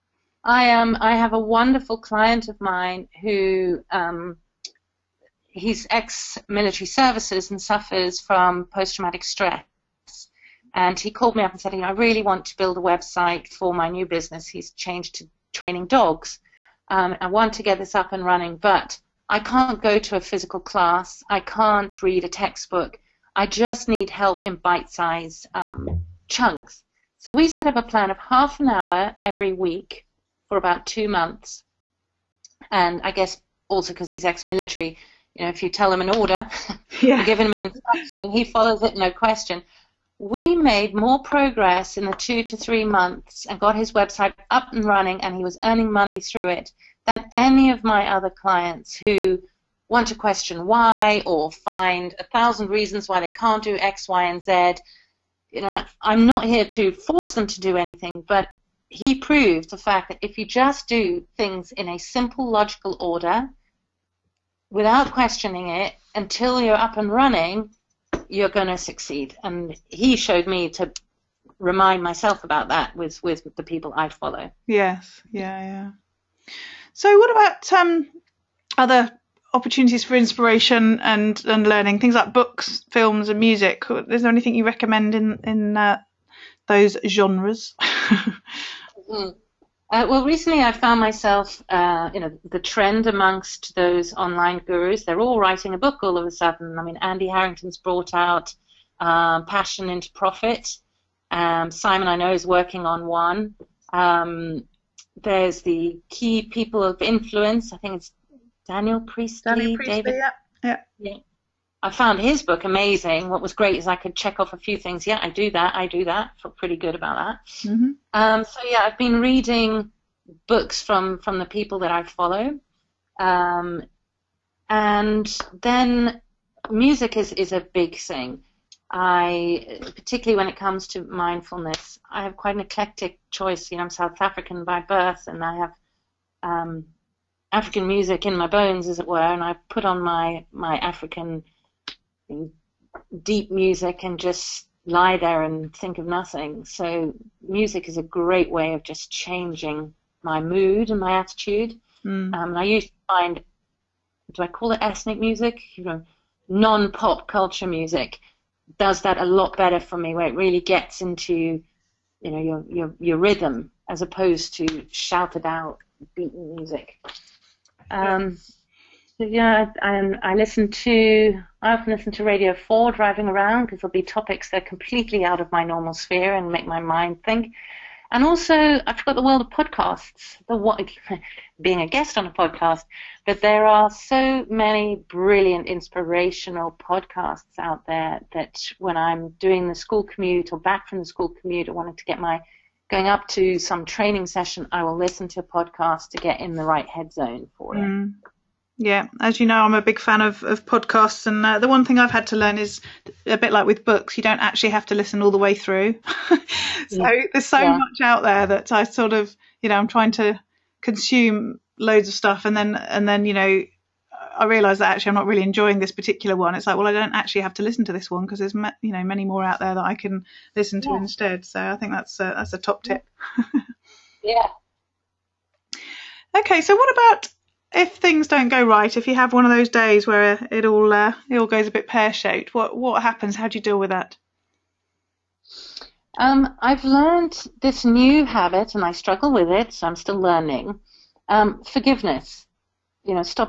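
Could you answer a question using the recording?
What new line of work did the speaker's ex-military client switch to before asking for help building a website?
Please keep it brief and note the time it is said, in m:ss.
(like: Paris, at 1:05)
Training dogs, at 0:15.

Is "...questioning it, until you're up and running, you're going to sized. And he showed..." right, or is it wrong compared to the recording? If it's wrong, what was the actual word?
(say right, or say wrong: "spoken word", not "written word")
wrong: "succeed", not "sized".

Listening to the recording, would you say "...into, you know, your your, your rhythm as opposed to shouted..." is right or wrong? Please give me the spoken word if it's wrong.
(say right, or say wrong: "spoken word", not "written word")
right.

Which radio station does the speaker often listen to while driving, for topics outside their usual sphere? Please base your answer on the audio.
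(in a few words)
Radio Four.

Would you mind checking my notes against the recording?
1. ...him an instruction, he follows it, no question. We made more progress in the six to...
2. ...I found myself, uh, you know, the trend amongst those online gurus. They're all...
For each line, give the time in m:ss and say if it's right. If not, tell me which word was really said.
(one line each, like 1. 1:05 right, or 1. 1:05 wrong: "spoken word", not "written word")
1. 0:37 wrong: "two", not "six"
2. 1:30 right.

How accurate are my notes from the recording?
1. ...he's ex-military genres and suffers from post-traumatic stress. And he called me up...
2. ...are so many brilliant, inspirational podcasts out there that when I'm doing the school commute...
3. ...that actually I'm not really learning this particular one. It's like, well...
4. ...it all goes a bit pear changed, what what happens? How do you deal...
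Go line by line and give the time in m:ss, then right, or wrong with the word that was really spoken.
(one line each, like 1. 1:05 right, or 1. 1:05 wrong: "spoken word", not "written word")
1. 0:05 wrong: "services", not "genres"
2. 3:03 right
3. 3:34 wrong: "enjoying", not "learning"
4. 3:51 wrong: "shaped", not "changed".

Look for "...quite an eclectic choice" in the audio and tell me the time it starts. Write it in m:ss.
2:12.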